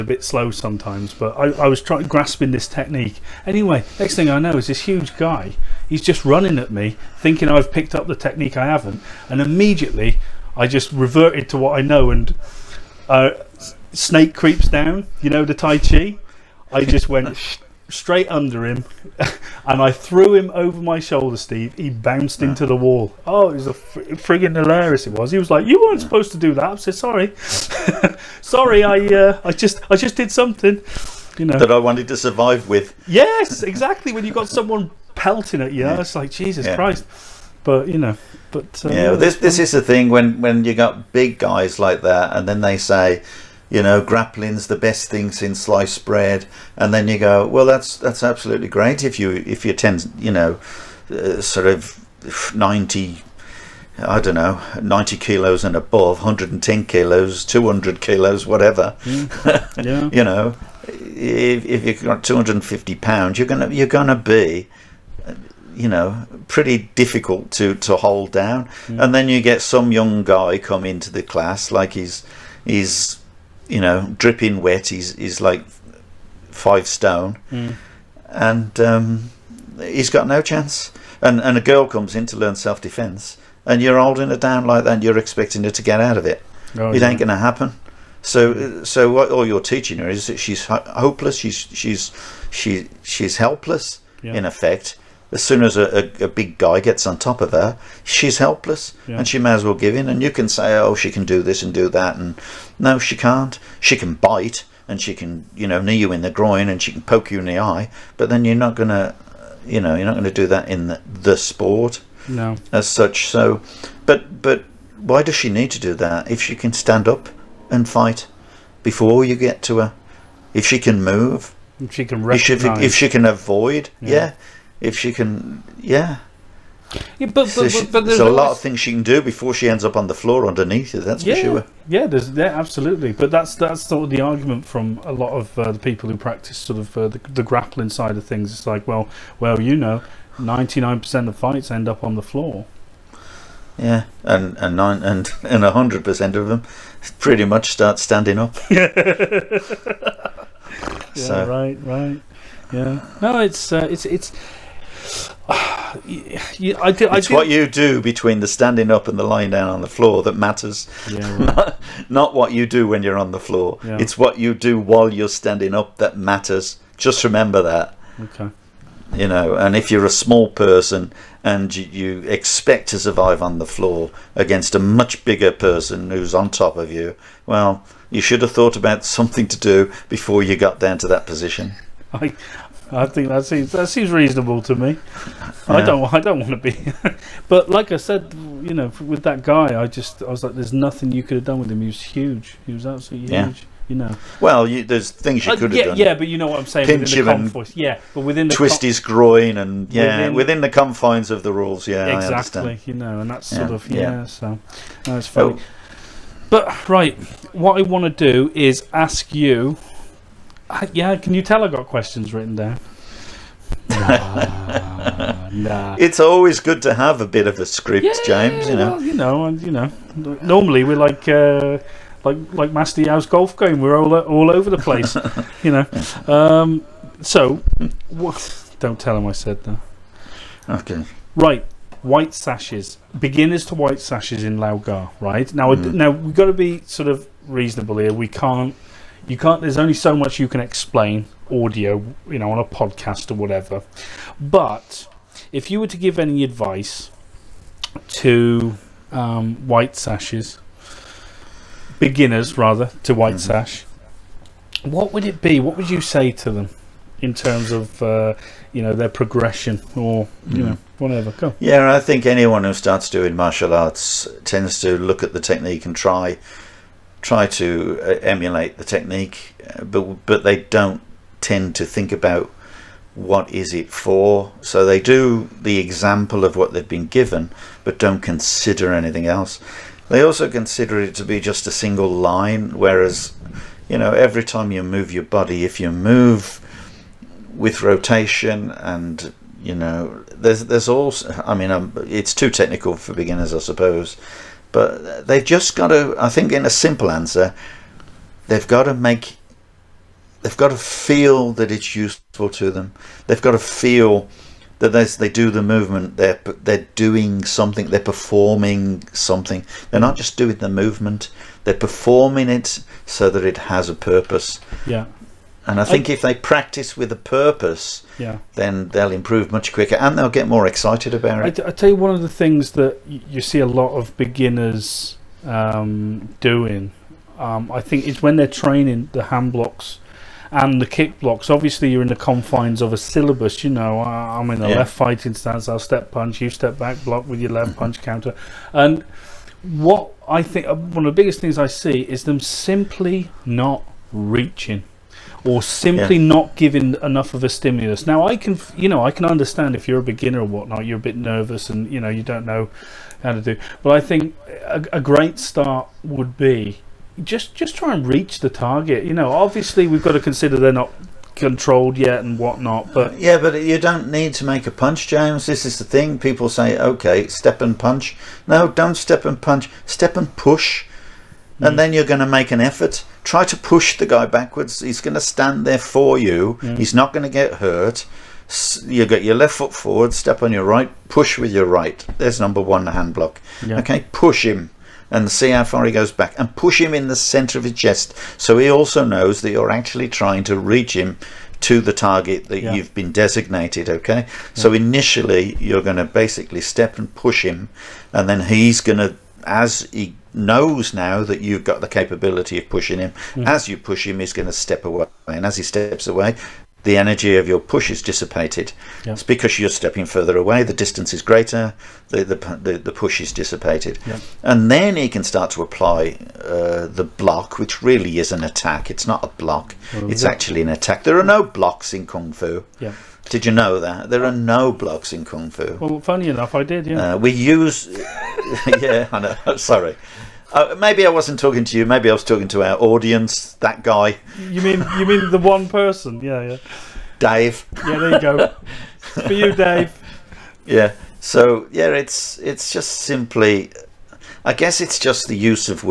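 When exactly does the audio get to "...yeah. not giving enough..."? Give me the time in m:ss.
5:46.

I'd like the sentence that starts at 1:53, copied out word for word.
So, but, but why does she need to do that if she can stand up and fight before you get to her?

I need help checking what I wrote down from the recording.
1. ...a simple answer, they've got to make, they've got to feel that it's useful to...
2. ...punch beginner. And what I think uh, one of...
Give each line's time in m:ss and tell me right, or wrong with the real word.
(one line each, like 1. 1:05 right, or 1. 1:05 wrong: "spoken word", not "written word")
1. 4:56 right
2. 5:37 wrong: "counter", not "beginner".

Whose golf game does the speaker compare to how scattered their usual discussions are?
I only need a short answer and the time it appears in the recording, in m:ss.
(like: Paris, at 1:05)
Master Yao's, at 3:42.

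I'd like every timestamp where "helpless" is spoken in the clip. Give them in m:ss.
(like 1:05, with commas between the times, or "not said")
1:33, 1:38.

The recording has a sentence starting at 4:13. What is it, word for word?
sash what would it be what would you say to them in terms of uh, you know their progression or you mm.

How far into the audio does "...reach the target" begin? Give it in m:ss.
5:58.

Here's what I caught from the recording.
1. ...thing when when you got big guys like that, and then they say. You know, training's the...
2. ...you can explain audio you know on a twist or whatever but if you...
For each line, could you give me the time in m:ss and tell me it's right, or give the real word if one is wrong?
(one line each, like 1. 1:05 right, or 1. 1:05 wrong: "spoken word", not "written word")
1. 0:39 wrong: "grappling", not "training"
2. 4:00 wrong: "podcast", not "twist".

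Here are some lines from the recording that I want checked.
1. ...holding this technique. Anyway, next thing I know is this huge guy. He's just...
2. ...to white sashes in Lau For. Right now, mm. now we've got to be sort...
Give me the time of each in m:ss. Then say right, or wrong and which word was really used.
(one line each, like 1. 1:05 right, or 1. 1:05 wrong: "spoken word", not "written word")
1. 0:02 wrong: "grasping", not "holding"
2. 3:53 wrong: "Gar", not "For".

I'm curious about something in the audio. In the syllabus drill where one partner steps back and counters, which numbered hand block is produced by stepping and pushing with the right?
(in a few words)
Number one.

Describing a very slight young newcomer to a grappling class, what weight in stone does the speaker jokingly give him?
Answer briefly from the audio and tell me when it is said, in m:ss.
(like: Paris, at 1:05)
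5 stone, at 1:16.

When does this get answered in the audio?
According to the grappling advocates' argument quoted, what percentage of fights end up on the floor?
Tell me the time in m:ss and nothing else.
2:20.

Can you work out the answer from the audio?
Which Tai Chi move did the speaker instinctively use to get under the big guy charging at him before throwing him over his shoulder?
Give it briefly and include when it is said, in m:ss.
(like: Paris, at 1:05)
Snake creeps down, at 0:13.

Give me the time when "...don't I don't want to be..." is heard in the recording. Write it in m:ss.
3:05.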